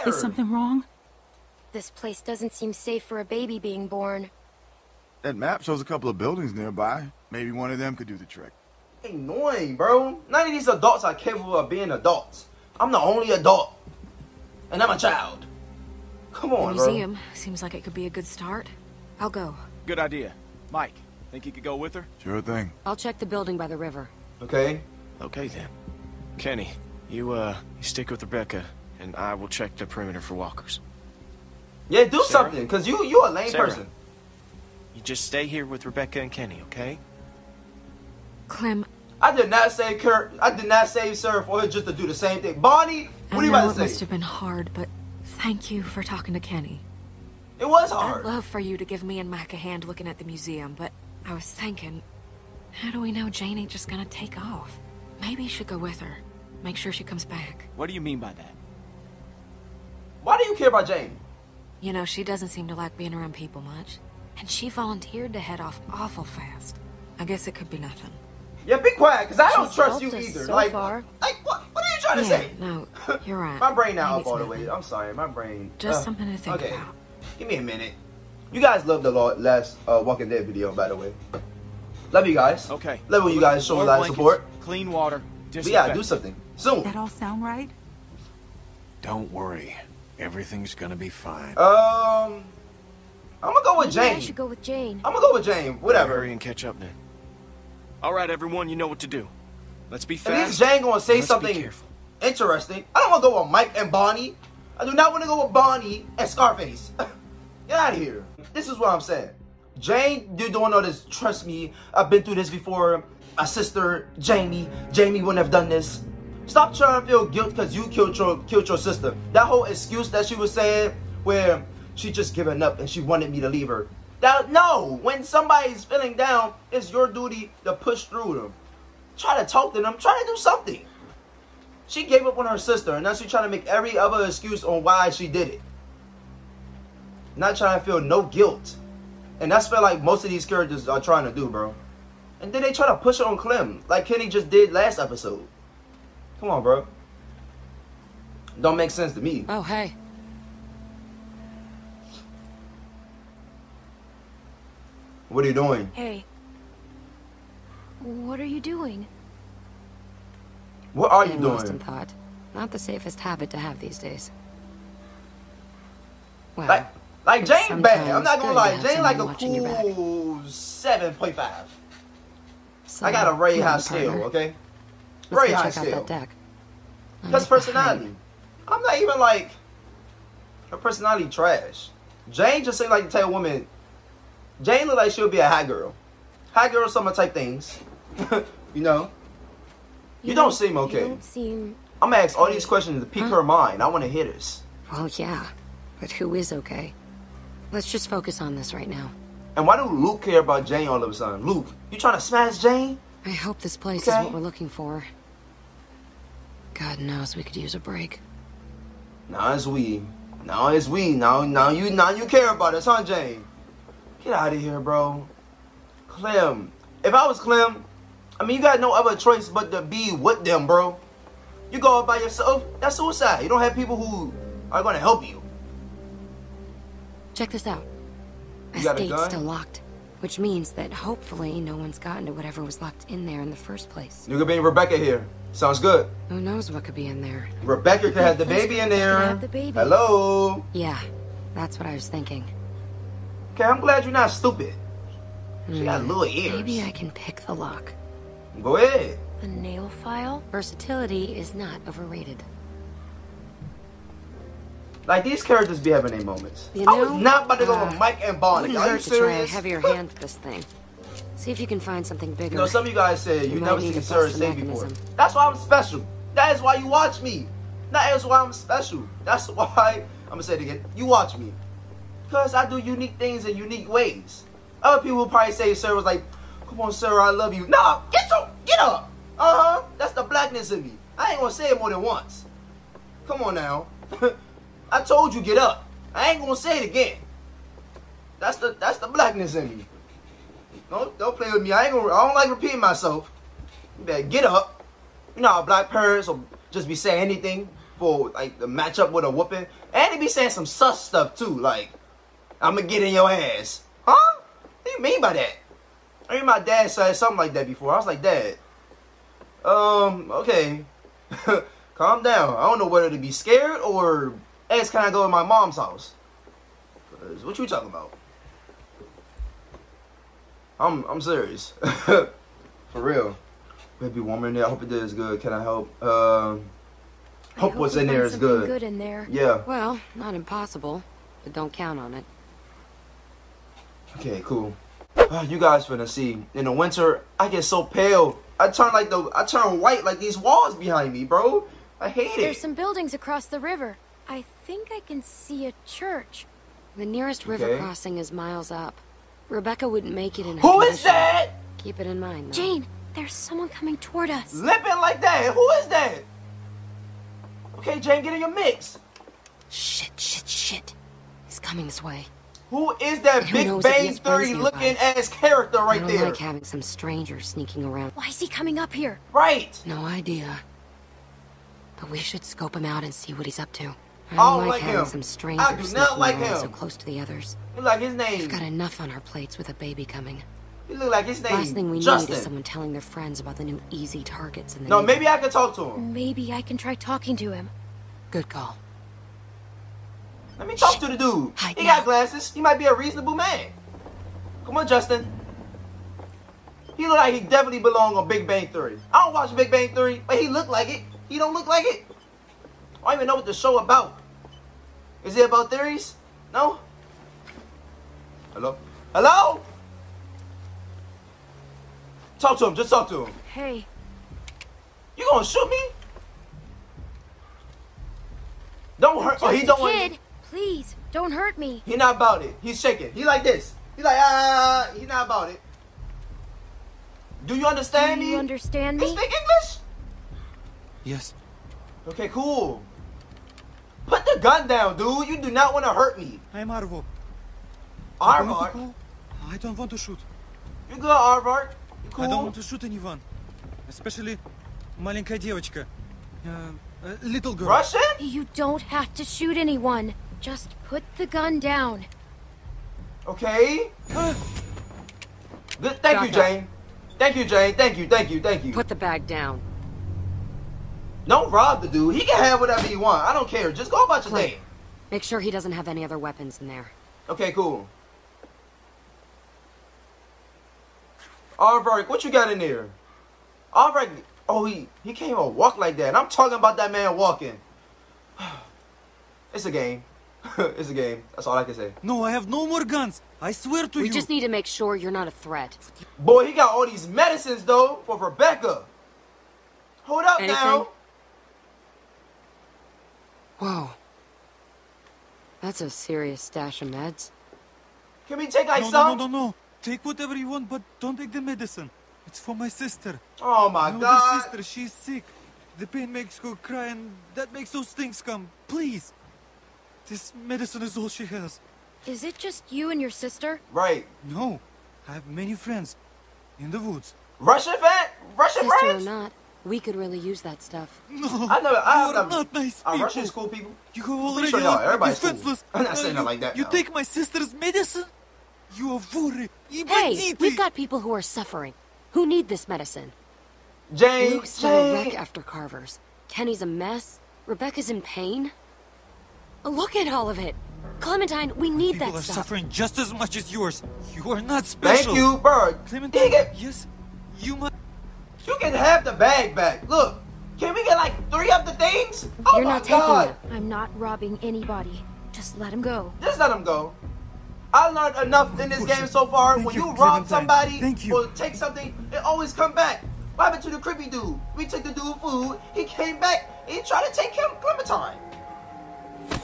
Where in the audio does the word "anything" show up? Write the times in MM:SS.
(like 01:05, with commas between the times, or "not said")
04:57, 08:10.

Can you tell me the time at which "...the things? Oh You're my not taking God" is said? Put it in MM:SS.
09:11.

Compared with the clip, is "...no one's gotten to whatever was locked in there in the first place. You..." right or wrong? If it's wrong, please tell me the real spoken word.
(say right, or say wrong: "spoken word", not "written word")
right.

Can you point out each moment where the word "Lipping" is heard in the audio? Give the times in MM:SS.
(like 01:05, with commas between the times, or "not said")
05:54.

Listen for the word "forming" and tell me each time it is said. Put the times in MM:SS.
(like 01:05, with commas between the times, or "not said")
not said.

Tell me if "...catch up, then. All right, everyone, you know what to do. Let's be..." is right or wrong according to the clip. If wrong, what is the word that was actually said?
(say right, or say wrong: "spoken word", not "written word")
right.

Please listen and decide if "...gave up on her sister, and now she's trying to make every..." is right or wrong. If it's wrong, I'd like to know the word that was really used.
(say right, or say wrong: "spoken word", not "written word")
right.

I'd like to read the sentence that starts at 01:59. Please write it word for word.
That whole excuse that she was saying where she just given up and she wanted me to leave her.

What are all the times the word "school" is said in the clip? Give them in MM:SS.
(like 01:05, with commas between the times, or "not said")
08:43.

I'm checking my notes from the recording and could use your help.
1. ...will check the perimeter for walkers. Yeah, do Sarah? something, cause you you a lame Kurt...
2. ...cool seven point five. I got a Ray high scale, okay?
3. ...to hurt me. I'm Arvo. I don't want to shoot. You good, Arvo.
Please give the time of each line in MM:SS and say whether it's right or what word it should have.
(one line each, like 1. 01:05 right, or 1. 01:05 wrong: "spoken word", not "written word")
1. 00:29 wrong: "Sarah", not "Kurt"
2. 02:49 right
3. 07:15 right.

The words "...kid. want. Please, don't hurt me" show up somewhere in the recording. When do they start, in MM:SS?
06:59.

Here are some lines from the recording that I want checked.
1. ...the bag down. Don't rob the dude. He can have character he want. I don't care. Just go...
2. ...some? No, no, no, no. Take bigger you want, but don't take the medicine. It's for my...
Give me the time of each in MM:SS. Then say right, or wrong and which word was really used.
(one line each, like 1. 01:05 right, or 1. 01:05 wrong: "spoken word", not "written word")
1. 07:38 wrong: "whatever", not "character"
2. 08:18 wrong: "whatever", not "bigger".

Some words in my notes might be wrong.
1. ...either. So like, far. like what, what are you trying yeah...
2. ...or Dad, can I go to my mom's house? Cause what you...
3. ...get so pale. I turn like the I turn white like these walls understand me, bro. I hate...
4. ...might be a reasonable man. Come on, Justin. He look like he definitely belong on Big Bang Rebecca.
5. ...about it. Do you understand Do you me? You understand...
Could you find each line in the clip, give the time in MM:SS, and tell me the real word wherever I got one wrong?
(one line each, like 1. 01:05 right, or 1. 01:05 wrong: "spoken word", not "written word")
1. 01:10 right
2. 05:13 wrong: "Ask", not "Dad"
3. 05:37 wrong: "behind", not "understand"
4. 06:32 wrong: "Theory", not "Rebecca"
5. 07:05 right.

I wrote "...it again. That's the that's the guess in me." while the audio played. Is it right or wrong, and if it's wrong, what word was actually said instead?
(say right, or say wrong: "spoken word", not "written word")
wrong: "blackness", not "guess".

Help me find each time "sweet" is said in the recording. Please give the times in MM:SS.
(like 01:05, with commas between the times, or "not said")
not said.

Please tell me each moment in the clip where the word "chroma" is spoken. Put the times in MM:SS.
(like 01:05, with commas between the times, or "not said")
not said.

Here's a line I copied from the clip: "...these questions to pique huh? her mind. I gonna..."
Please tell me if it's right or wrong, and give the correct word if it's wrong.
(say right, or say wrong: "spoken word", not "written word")
wrong: "wanna", not "gonna".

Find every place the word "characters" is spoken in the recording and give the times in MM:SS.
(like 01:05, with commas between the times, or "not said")
02:20, 04:15, 06:05.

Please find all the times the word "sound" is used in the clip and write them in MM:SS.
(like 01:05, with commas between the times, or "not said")
01:27, 03:55.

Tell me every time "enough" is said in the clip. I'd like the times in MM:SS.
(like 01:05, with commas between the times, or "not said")
06:18, 09:18.